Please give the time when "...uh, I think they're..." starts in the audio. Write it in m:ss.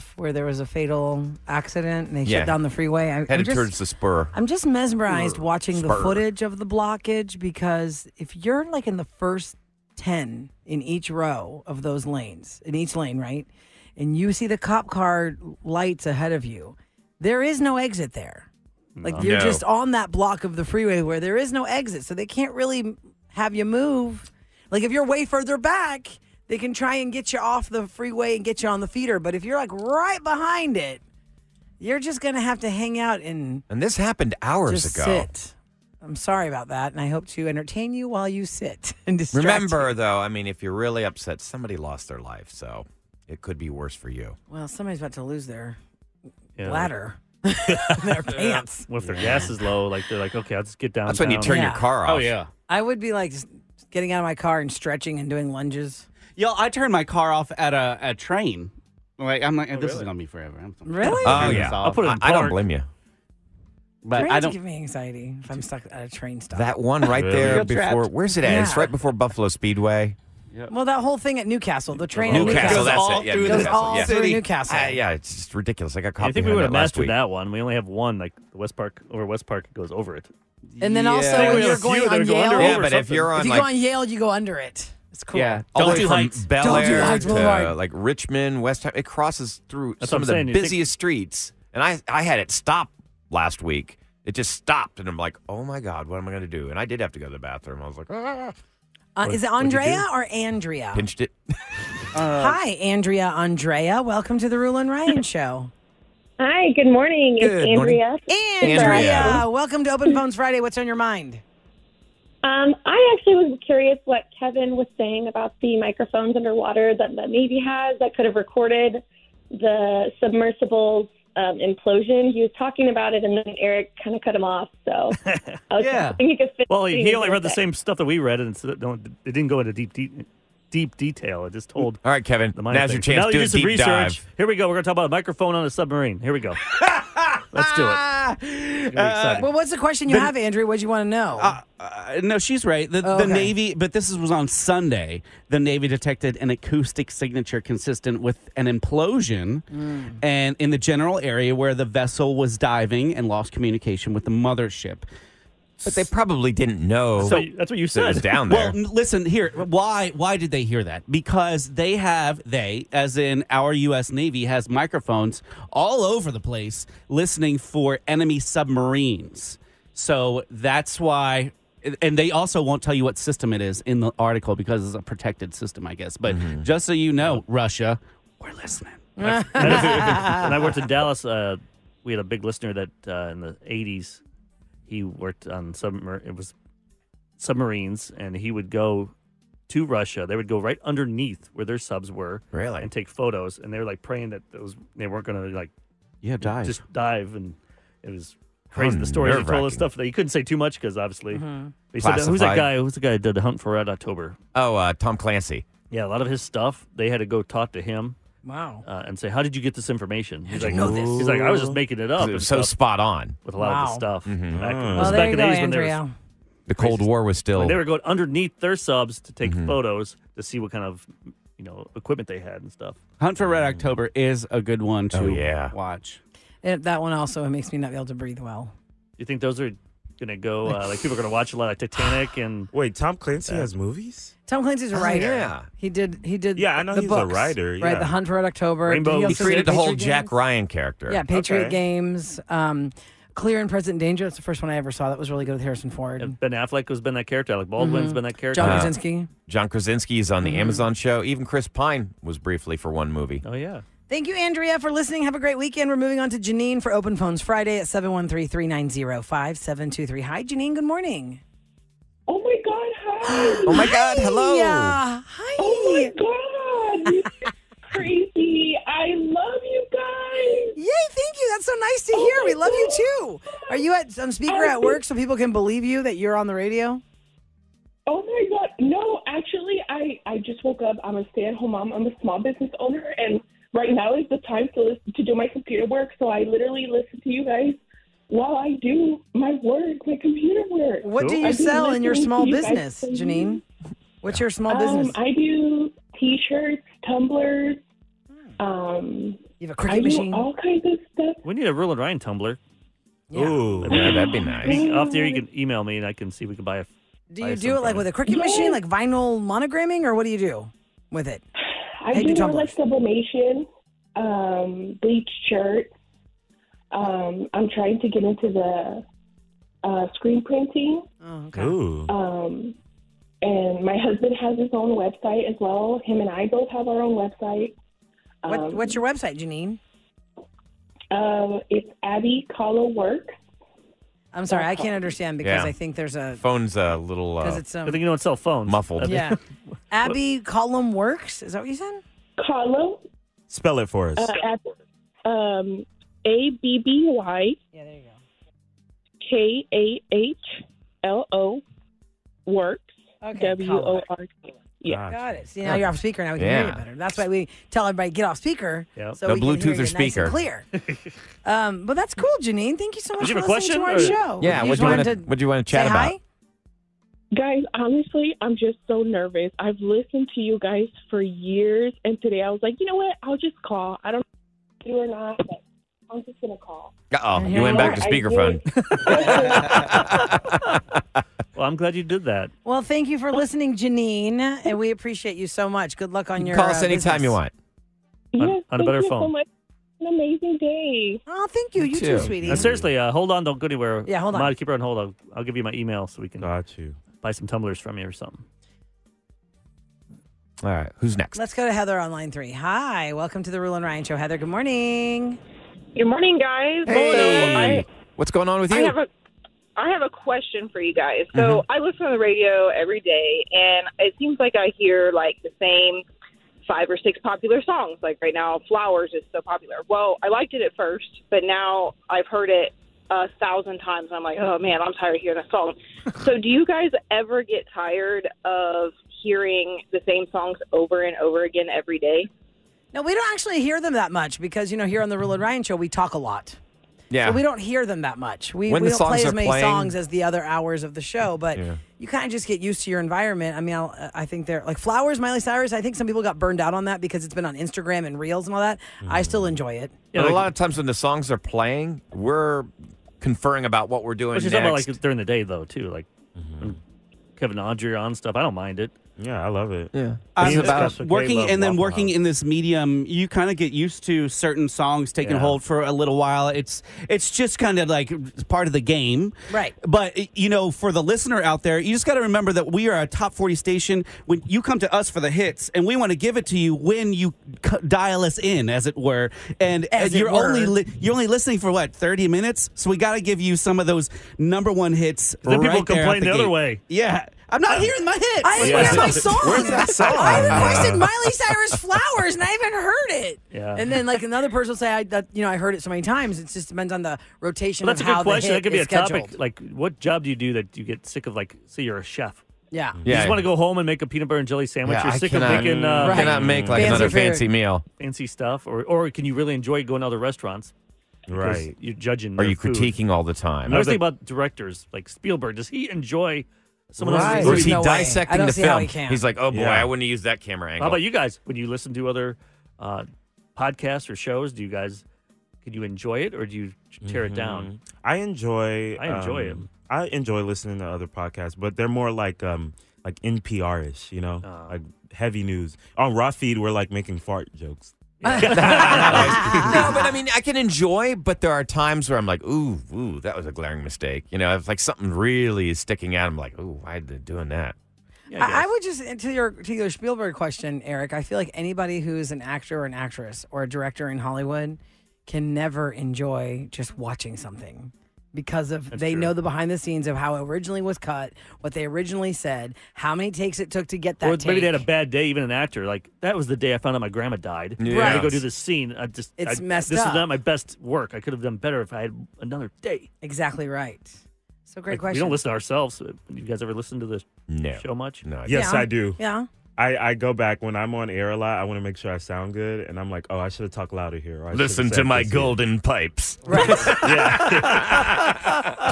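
7:23.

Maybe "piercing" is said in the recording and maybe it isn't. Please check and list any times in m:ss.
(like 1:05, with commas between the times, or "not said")
not said.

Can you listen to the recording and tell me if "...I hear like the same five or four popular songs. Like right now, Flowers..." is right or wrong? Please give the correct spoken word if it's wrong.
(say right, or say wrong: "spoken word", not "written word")
wrong: "six", not "four".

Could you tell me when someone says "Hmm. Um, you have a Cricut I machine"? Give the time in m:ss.
4:58.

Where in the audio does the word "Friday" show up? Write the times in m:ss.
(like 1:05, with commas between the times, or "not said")
1:50, 4:17.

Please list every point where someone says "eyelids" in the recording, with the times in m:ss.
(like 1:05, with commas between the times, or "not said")
not said.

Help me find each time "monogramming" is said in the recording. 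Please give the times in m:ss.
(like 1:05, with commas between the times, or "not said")
5:09.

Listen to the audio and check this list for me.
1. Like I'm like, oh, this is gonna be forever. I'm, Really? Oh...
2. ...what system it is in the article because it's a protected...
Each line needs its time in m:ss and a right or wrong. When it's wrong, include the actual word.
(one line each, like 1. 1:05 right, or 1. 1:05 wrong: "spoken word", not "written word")
1. 0:59 right
2. 2:53 right.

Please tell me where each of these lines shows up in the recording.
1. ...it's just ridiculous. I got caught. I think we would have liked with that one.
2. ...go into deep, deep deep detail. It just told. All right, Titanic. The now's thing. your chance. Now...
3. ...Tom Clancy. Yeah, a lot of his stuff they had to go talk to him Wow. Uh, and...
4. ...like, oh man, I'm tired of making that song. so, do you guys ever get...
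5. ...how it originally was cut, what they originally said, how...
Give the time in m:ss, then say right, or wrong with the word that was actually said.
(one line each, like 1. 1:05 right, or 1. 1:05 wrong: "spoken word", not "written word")
1. 1:15 wrong: "messed", not "liked"
2. 2:09 wrong: "Kevin", not "Titanic"
3. 3:24 right
4. 7:04 wrong: "hearing", not "making"
5. 9:20 right.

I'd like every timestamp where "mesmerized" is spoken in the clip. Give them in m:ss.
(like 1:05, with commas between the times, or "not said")
0:04.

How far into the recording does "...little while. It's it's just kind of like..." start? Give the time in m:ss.
7:45.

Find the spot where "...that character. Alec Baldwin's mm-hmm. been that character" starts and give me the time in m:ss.
4:07.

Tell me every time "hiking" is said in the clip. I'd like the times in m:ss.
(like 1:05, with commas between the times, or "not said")
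not said.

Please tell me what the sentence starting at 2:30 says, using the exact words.
and in the general area where the vessel was diving and lost communication with the mothership.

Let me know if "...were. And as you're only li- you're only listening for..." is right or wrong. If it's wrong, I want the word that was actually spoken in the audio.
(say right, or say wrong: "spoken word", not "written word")
right.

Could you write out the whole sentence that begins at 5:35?
I think there's a Phone's a little because uh, it's I um, think you don't sell phones.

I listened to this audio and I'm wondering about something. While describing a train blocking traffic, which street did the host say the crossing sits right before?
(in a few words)
Buffalo Speedway.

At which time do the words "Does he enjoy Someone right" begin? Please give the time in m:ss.
8:35.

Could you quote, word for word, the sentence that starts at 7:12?
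Now, we don't actually hear them that much because, you know, here on the Real and Ryan show, we talk a lot.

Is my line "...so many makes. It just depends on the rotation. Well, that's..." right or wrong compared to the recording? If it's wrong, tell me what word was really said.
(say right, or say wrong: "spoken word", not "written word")
wrong: "times", not "makes".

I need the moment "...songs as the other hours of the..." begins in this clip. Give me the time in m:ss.
7:19.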